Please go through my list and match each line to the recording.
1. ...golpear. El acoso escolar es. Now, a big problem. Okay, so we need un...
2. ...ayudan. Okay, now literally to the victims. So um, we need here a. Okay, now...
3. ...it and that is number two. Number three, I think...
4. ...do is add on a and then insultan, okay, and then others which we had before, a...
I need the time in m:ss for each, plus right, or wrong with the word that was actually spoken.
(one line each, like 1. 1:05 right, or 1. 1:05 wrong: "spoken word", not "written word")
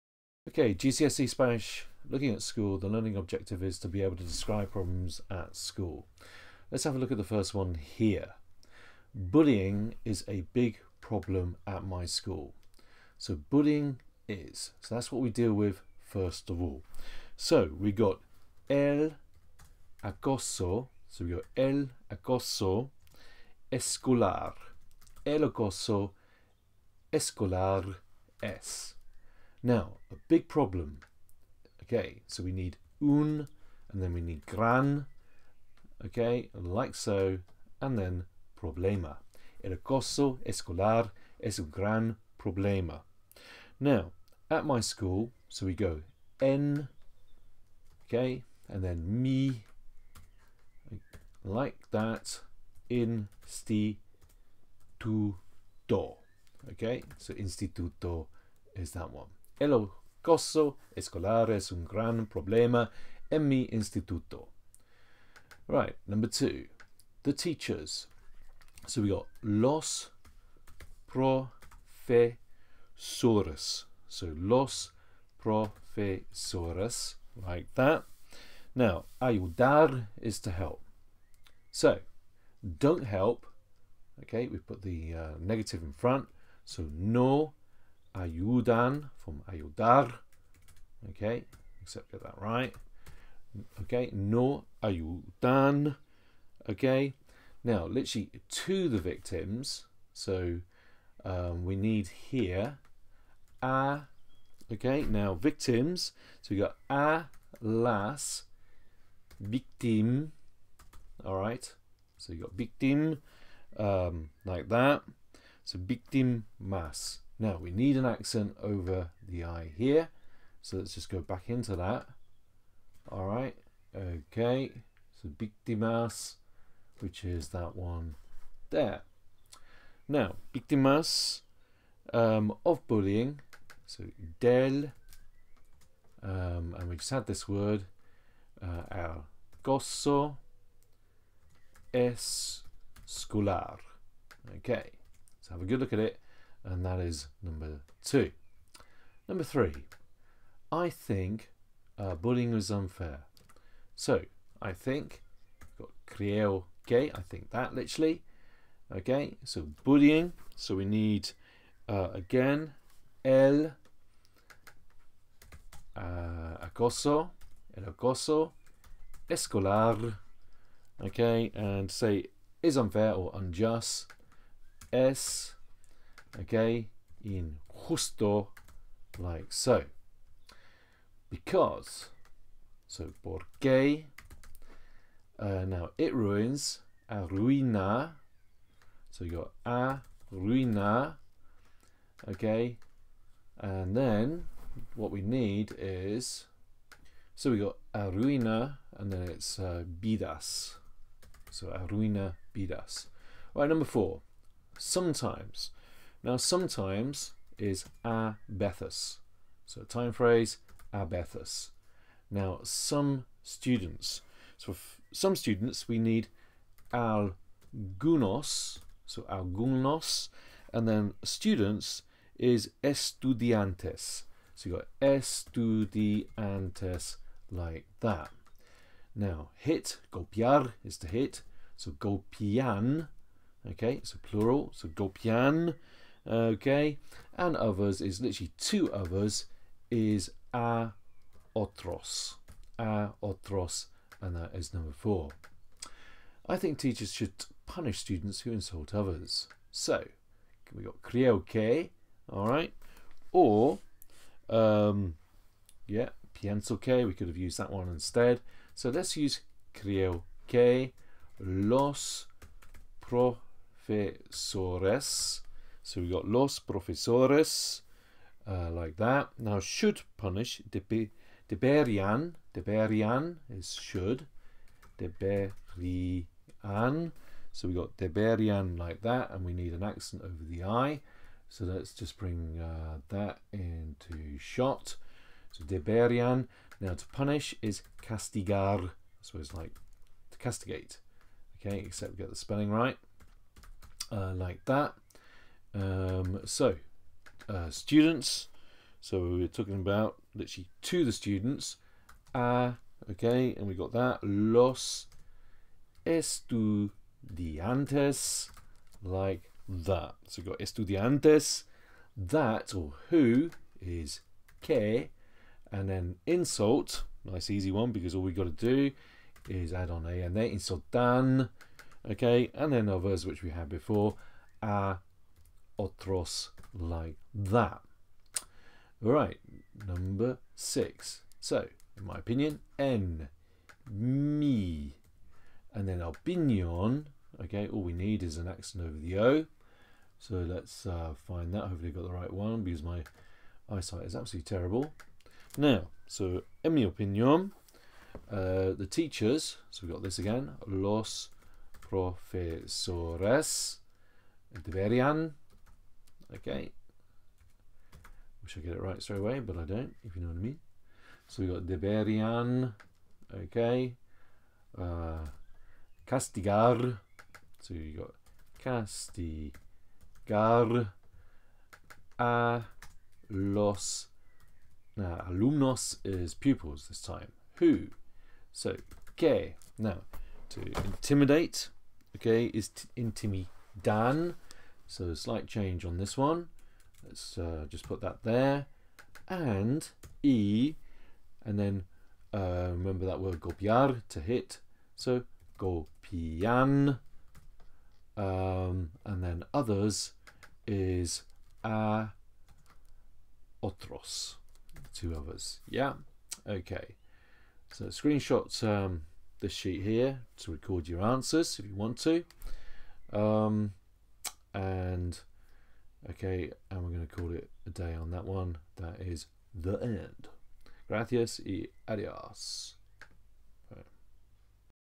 1. 0:23 wrong: "escolar", not "golpear"
2. 1:34 right
3. 2:25 right
4. 5:18 right.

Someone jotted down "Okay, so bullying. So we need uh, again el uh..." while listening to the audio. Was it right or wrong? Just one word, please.
right.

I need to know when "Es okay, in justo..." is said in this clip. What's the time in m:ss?
2:54.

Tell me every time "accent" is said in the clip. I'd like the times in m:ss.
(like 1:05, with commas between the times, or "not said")
1:58, 4:39, 5:38.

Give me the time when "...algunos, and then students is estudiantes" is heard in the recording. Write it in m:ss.
3:39.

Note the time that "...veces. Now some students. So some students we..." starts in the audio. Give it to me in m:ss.
3:31.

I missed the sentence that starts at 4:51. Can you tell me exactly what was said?
Okay, except we get the spelling right, uh, like that.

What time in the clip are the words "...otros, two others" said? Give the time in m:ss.
6:43.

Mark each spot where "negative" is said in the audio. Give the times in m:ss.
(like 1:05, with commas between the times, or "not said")
1:25.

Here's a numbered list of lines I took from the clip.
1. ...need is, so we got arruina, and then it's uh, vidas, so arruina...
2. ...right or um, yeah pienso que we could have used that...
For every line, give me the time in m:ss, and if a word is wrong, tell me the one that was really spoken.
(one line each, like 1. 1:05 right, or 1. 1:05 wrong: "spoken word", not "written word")
1. 3:15 right
2. 4:12 right.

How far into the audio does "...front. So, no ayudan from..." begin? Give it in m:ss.
1:25.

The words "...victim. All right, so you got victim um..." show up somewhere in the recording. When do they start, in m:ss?
1:49.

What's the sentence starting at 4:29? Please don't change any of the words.
Now, should punish, deberian, deberian is should, deberian.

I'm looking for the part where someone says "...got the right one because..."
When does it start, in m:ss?
5:41.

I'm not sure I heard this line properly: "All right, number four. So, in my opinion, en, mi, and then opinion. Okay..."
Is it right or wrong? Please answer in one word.
wrong.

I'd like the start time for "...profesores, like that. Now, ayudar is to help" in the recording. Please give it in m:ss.
1:15.